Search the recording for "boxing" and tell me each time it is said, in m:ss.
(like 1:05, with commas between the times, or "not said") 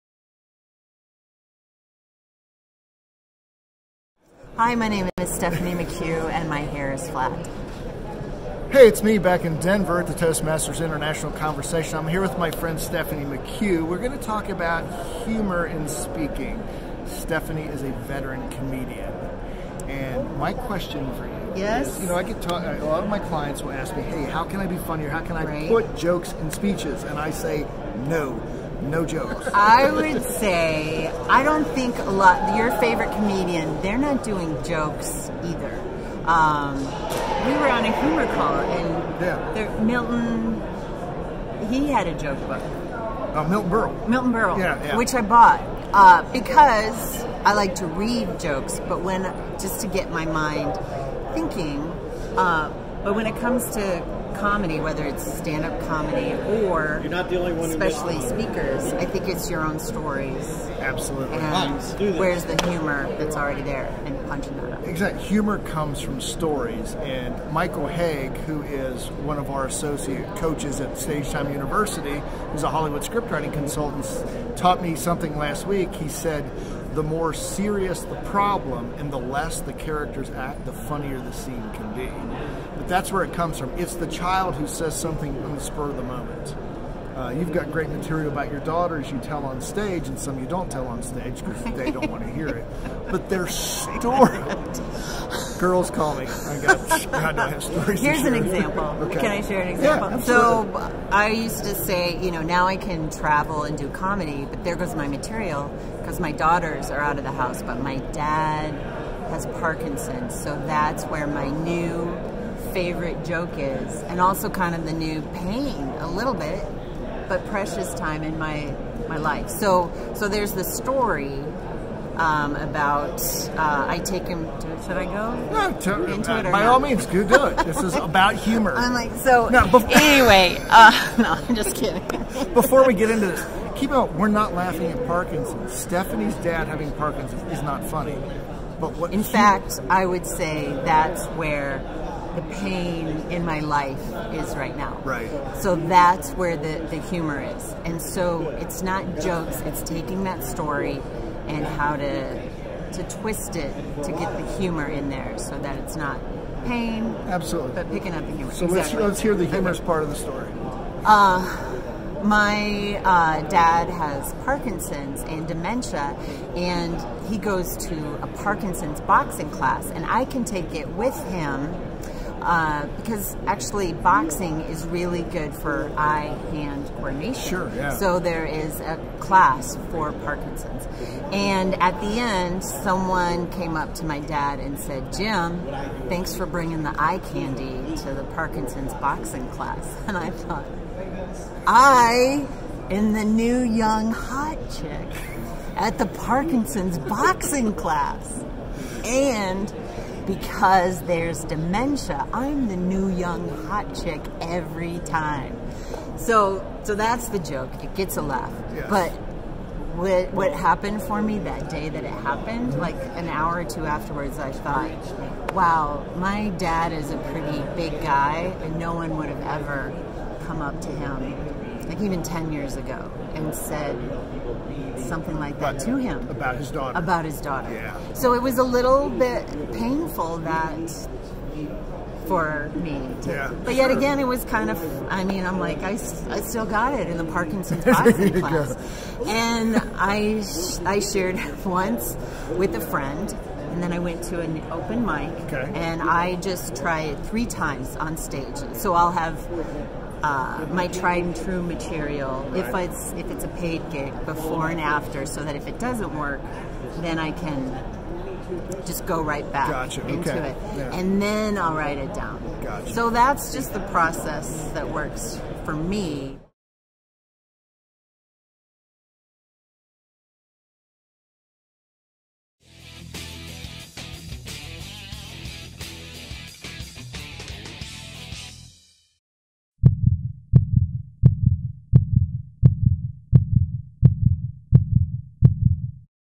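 2:49, 2:53, 3:08, 3:16.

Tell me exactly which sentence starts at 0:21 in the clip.
Is, you know, I get talk.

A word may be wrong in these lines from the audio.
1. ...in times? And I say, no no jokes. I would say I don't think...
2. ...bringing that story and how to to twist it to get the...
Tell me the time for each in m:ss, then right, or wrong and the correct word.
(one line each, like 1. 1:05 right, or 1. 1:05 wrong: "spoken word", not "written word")
1. 0:26 wrong: "speeches", not "times"
2. 2:29 wrong: "taking", not "bringing".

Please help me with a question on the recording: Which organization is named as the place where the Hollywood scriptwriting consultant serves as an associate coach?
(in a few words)
Stage Time University.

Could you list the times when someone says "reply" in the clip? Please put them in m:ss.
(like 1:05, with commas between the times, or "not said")
not said.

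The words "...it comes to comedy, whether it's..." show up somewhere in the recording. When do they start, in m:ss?
0:53.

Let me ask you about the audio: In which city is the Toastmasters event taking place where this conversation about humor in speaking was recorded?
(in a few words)
Denver.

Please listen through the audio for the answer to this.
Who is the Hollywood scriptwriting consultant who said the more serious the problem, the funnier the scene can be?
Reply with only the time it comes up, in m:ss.
1:07.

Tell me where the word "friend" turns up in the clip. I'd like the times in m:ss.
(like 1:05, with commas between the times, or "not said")
0:12, 4:02.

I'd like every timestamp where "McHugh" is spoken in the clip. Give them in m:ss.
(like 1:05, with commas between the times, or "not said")
0:05, 0:13.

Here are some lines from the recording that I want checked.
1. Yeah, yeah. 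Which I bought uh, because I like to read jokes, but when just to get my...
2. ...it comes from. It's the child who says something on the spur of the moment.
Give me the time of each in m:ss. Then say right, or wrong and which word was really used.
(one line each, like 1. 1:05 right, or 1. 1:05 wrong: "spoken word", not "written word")
1. 0:44 right
2. 1:23 right.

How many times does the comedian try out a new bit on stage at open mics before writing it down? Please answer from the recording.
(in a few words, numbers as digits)
3.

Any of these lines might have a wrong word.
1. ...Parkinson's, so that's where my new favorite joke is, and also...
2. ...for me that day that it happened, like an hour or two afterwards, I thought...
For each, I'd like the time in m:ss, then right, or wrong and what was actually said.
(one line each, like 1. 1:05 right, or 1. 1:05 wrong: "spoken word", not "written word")
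1. 1:49 right
2. 3:31 right.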